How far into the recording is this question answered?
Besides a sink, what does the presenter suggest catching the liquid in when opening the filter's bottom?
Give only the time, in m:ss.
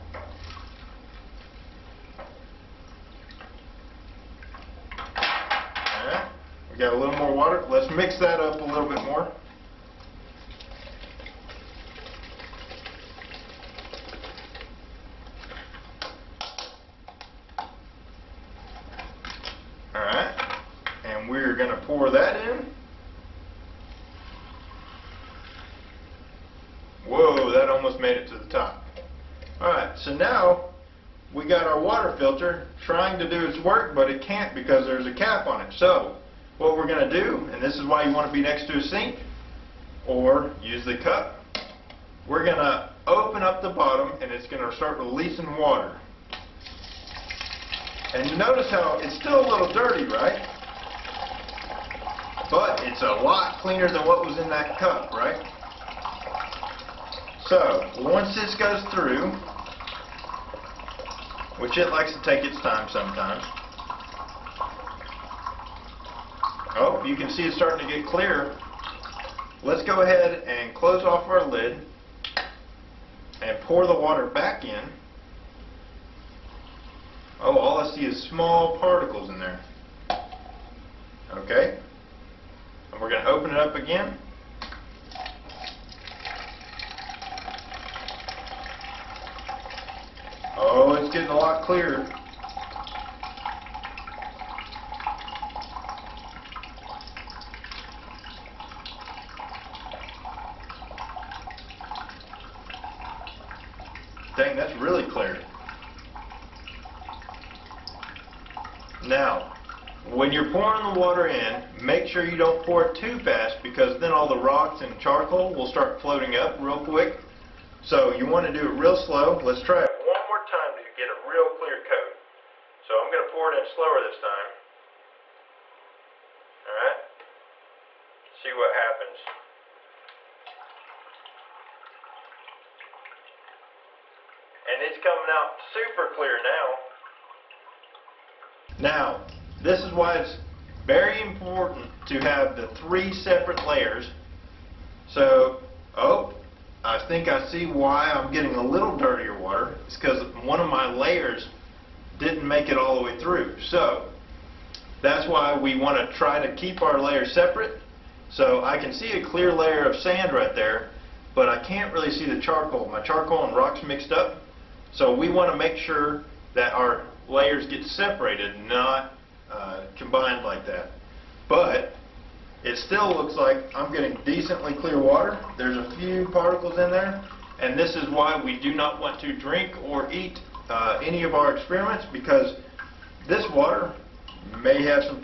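0:40.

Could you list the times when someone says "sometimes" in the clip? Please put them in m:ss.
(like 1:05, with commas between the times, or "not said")
1:02.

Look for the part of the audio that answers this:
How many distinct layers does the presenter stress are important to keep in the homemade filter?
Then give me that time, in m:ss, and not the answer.
2:22.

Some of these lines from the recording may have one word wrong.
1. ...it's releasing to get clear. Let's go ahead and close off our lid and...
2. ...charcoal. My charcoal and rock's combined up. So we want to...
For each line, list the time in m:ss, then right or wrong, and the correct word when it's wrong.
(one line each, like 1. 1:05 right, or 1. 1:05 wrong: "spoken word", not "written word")
1. 1:07 wrong: "starting", not "releasing"
2. 2:42 wrong: "mixed", not "combined".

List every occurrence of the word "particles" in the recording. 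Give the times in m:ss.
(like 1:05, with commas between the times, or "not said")
1:18, 2:56.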